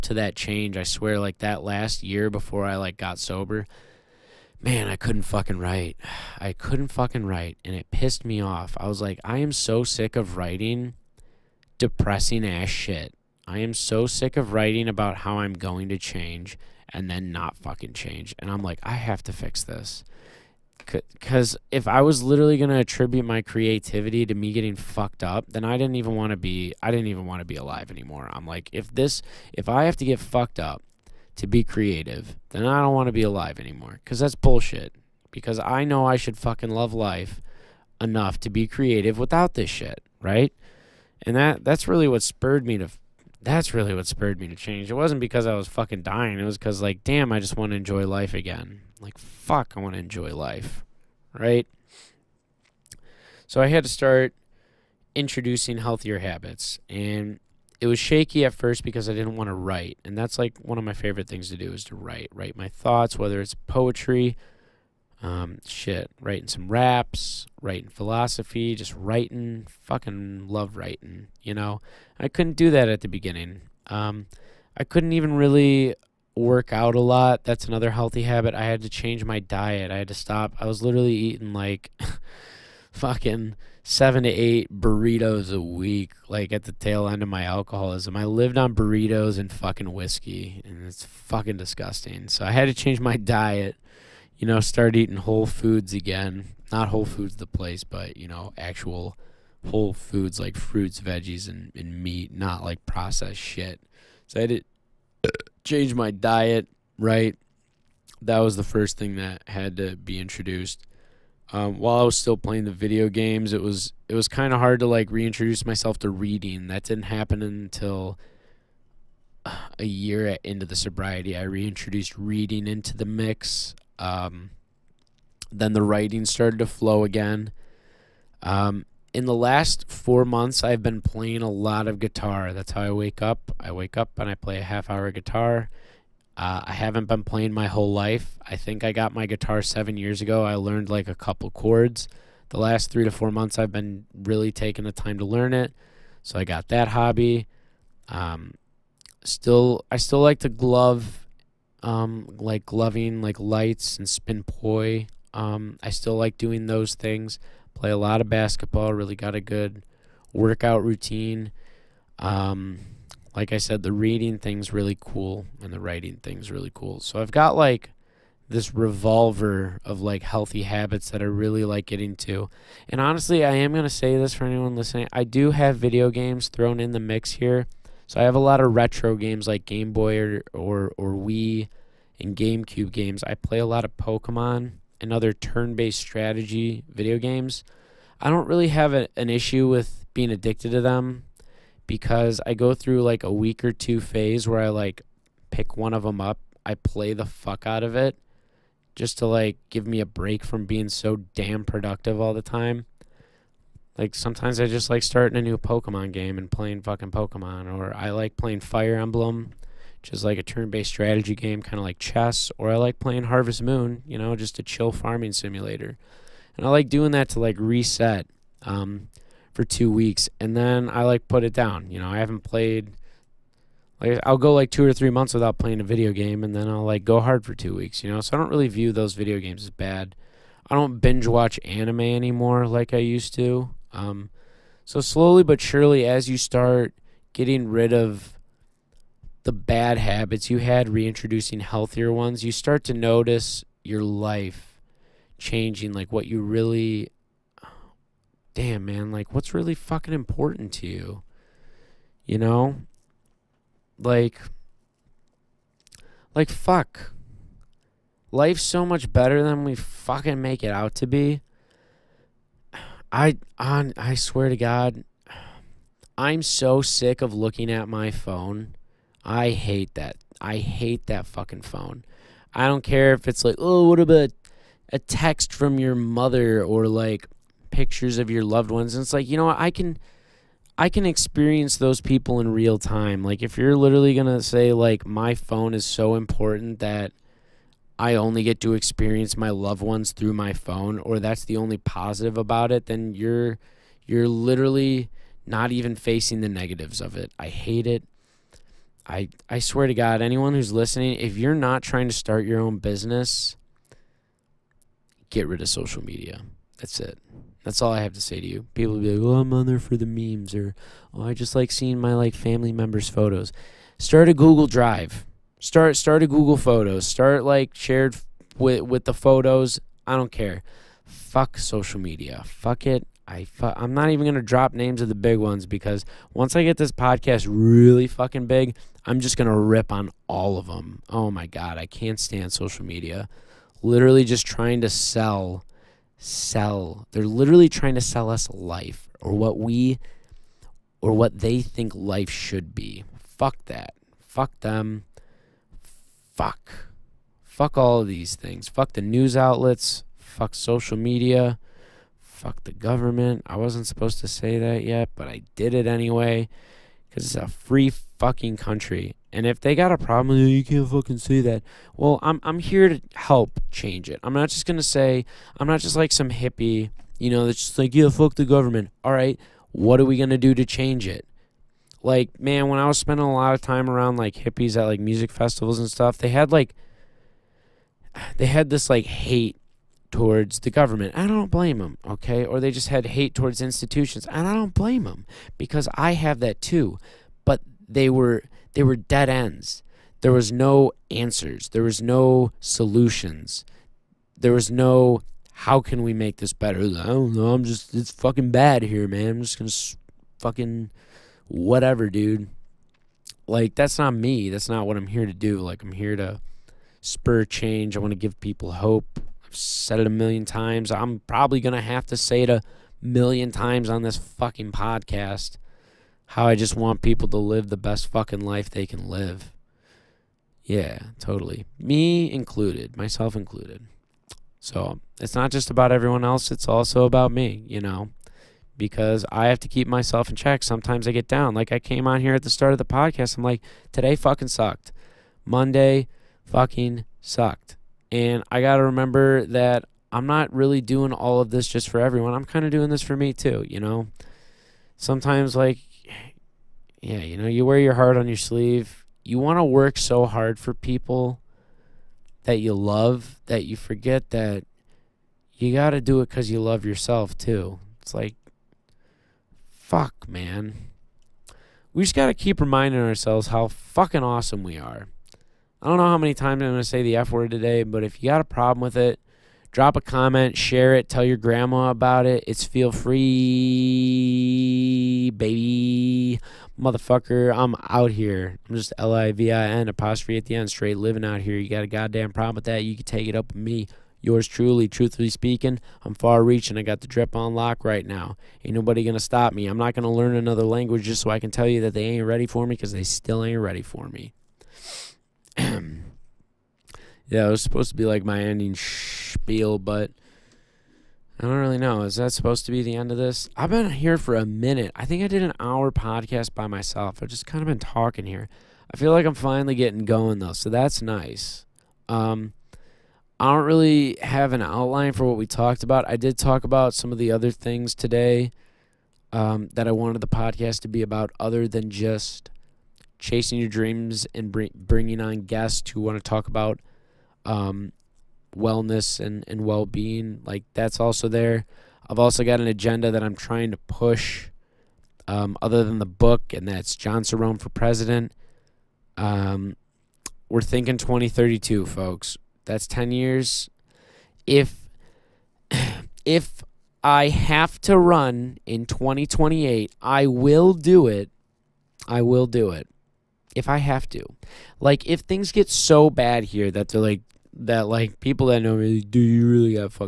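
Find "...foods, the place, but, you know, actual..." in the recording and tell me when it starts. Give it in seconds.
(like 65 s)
97 s.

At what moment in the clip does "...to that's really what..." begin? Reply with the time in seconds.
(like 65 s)
42 s.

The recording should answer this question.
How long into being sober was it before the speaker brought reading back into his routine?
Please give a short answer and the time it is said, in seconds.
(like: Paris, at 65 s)
a year, at 119 s.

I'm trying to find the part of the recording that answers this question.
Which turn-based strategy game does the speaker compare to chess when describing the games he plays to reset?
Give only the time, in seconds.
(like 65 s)
208 s.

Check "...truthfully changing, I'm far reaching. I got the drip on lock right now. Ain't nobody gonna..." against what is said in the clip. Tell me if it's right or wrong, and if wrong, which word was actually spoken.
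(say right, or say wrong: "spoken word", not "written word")
wrong: "speaking", not "changing".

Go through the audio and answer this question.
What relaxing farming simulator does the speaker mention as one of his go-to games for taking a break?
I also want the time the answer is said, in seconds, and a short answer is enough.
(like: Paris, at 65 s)
Harvest Moon, at 213 s.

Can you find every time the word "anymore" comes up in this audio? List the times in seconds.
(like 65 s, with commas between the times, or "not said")
27 s, 33 s, 232 s.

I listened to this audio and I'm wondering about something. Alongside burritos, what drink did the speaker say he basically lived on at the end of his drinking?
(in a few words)
whiskey.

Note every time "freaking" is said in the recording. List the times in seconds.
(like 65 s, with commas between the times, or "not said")
not said.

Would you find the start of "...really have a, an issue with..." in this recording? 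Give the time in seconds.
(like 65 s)
188 s.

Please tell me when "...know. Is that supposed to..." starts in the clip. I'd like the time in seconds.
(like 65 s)
501 s.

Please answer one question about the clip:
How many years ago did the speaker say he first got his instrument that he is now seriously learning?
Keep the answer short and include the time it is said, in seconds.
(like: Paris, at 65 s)
7 years, at 139 s.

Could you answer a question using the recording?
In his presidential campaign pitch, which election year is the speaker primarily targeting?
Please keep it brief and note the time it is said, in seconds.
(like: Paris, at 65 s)
2032, at 540 s.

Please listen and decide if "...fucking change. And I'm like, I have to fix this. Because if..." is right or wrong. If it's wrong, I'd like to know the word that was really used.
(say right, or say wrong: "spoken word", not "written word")
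right.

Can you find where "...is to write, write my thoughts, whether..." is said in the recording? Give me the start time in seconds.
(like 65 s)
61 s.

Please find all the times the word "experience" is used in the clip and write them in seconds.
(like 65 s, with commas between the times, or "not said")
281 s, 288 s.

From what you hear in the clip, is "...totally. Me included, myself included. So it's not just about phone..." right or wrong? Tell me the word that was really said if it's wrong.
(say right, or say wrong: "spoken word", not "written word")
wrong: "everyone", not "phone".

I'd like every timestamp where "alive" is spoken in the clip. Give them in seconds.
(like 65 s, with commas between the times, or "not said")
27 s, 33 s.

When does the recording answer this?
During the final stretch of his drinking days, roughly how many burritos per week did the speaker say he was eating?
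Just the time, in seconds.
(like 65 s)
83 s.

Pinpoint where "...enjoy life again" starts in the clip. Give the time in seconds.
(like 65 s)
47 s.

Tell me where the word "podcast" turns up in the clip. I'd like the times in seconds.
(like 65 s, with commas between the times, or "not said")
326 s, 414 s, 432 s, 505 s, 520 s.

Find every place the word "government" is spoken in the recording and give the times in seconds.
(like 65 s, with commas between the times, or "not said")
352 s, 368 s, 380 s.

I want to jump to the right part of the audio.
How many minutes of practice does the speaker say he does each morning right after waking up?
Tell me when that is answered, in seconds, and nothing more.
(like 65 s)
134 s.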